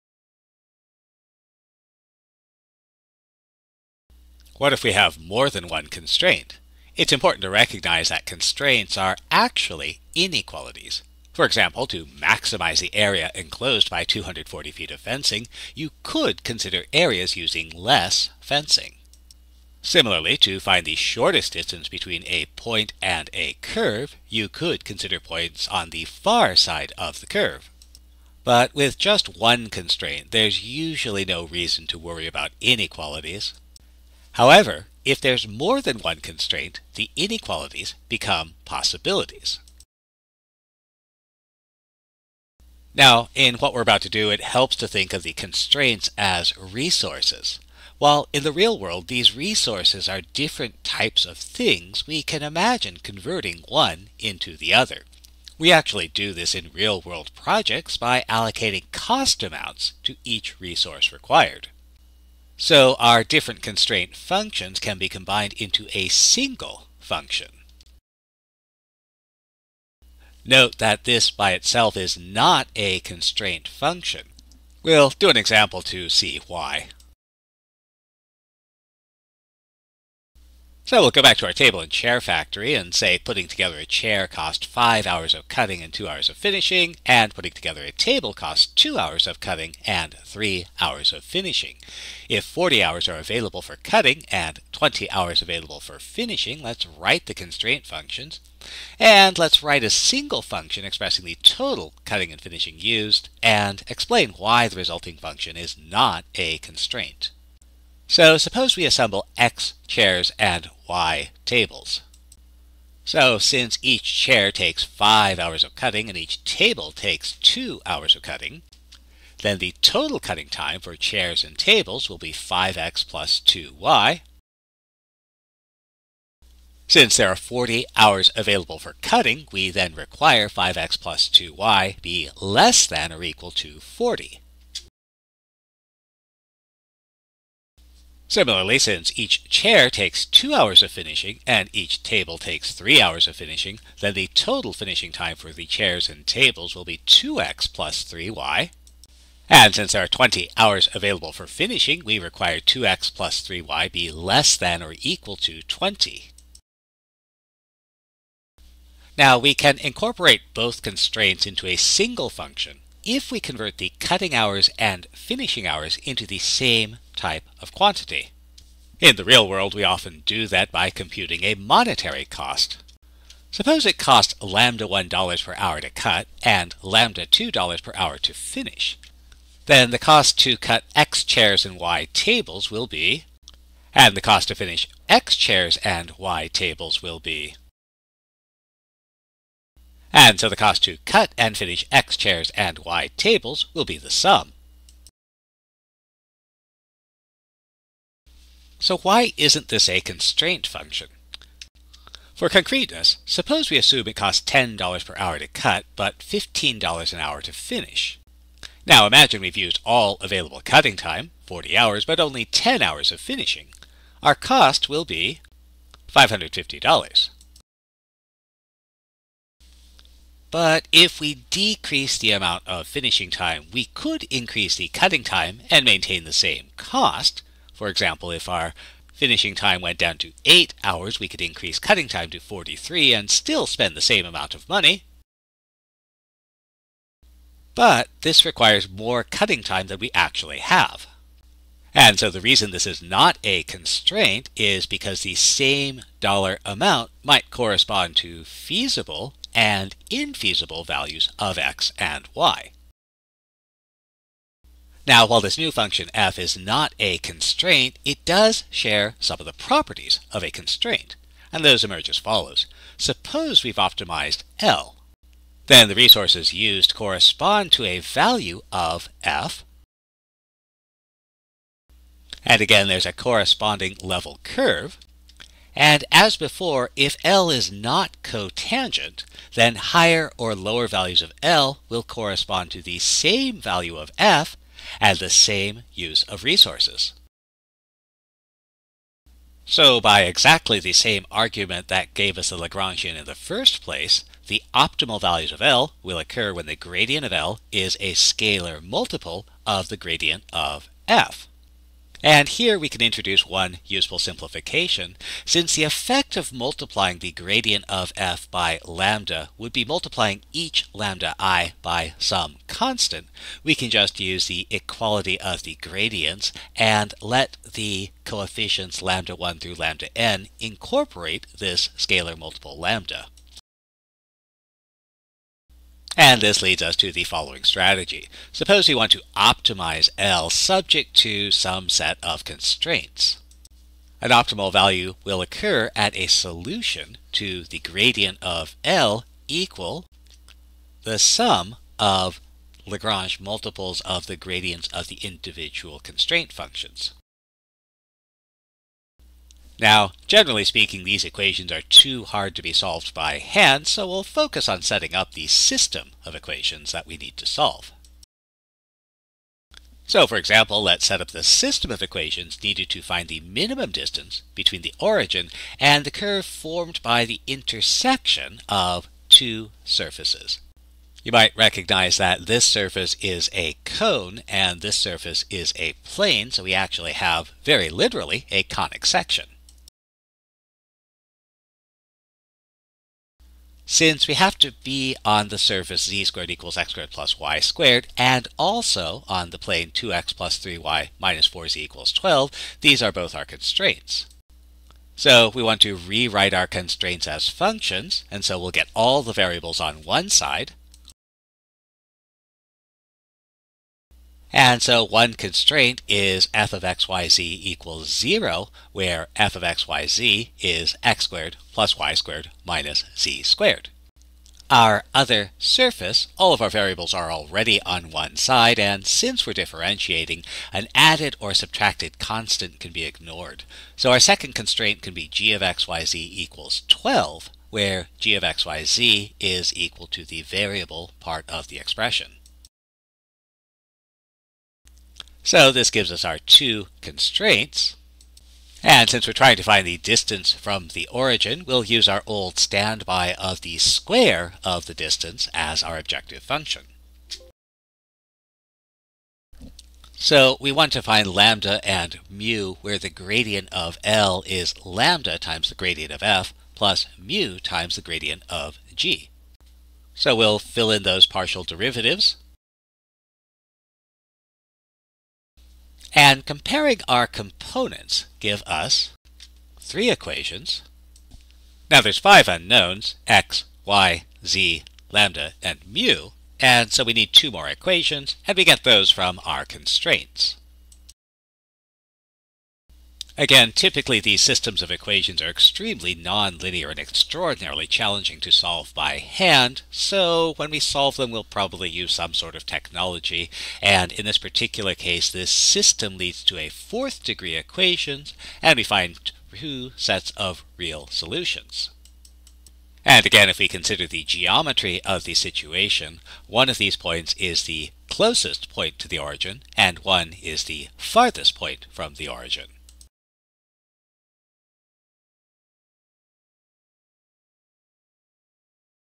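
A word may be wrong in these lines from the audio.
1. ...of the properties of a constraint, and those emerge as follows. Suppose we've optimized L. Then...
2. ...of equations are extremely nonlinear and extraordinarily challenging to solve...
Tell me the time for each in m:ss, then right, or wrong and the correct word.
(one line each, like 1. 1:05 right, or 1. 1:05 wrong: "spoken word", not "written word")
1. 4:19 right
2. 8:04 right.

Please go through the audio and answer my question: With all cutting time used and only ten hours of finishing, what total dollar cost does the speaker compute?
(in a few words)
$550.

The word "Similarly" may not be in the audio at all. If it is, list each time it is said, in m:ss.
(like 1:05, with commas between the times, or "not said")
0:19, 2:18.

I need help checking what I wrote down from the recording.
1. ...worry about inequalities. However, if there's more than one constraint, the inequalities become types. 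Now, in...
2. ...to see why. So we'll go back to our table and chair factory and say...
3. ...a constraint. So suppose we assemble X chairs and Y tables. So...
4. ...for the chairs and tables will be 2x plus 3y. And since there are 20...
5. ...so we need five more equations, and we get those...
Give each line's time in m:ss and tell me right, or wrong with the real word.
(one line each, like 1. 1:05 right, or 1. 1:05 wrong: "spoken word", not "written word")
1. 0:31 wrong: "possibilities", not "types"
2. 1:15 right
3. 1:46 right
4. 2:25 right
5. 7:56 wrong: "two", not "five".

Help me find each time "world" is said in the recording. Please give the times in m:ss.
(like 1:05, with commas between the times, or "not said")
0:48, 0:57, 2:49.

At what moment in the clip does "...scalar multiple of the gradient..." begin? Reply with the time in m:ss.
4:58.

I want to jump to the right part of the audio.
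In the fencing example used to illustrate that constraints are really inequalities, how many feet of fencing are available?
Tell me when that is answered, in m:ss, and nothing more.
0:14.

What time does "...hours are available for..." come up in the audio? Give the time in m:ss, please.
1:32.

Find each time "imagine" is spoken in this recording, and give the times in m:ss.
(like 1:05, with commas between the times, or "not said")
0:52, 3:29.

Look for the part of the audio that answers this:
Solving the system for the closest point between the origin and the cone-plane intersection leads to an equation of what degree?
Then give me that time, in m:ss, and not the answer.
8:16.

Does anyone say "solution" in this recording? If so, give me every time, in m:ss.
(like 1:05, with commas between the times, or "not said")
5:36, 8:21.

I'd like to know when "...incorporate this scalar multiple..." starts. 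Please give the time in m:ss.
5:20.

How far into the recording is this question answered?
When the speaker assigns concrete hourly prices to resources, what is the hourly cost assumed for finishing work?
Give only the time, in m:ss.
3:26.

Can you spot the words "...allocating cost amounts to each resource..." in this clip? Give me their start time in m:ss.
0:58.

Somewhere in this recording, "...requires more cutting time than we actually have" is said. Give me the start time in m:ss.
3:58.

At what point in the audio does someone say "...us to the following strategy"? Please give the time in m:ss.
5:26.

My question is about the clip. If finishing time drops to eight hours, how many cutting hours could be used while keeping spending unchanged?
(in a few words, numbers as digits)
43.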